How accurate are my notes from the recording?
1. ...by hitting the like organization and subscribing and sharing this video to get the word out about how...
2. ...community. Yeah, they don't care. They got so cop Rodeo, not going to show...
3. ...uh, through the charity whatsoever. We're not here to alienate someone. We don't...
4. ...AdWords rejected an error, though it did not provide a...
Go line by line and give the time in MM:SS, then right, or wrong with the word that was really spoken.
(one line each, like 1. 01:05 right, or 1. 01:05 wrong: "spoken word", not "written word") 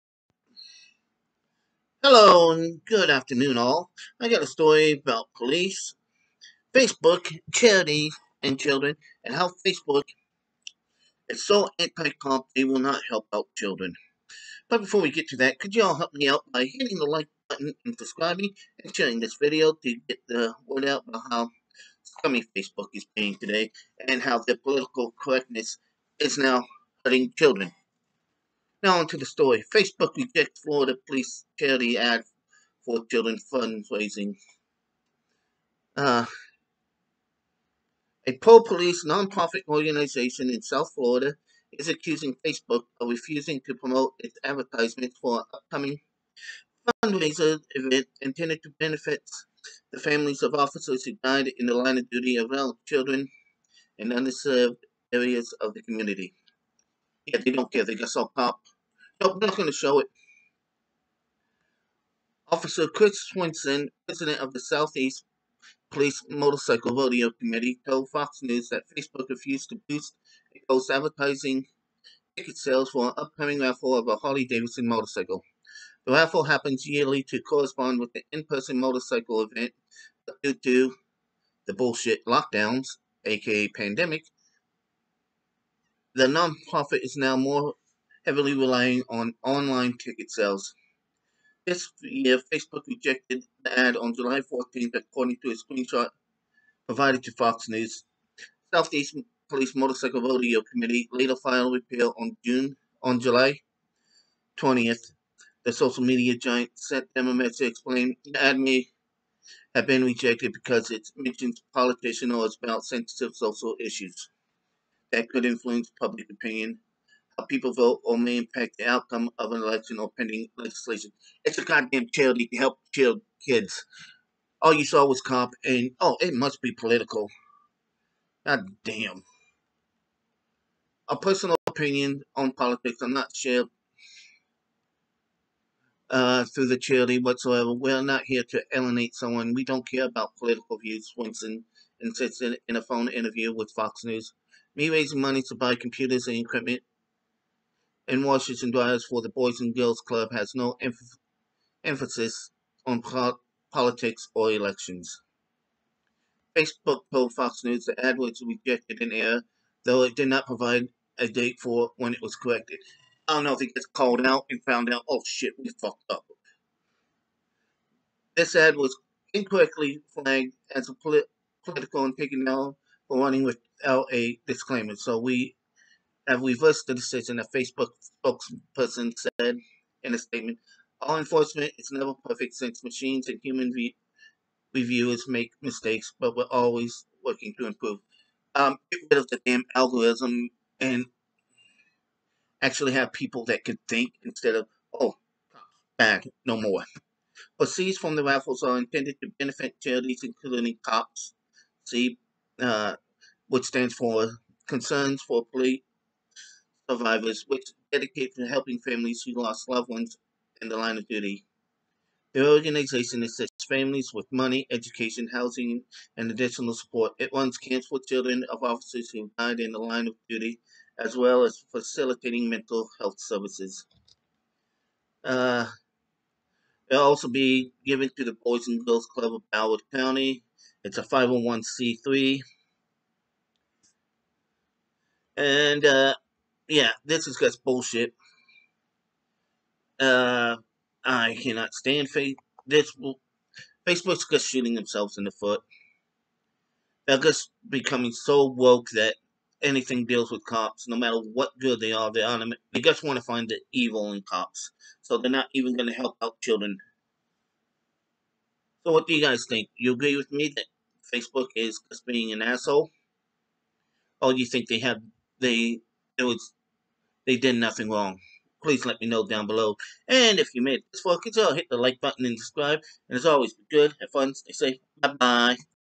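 1. 00:16 wrong: "button", not "organization"
2. 00:55 wrong: "Nope", not "Rodeo"
3. 02:16 right
4. 02:37 right.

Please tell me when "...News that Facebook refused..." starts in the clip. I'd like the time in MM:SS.
01:08.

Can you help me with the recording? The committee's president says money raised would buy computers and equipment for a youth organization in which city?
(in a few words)
Washington D.C.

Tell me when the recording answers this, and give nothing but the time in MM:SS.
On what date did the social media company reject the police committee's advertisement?
01:34.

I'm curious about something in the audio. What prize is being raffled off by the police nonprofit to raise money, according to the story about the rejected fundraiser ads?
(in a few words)
Harley Davidson motorcycle.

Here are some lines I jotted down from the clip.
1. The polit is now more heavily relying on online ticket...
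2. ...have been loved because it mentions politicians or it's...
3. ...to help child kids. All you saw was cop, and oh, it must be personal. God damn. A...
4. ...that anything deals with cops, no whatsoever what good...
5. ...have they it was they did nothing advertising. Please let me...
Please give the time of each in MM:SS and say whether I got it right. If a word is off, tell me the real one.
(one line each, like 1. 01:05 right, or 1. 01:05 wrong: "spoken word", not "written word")
1. 01:26 wrong: "nonprofit", not "polit"
2. 01:49 wrong: "rejected", not "loved"
3. 02:02 wrong: "political", not "personal"
4. 04:08 wrong: "matter", not "whatsoever"
5. 04:24 wrong: "wrong", not "advertising".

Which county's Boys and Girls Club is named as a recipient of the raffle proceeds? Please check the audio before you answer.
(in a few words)
Broward County.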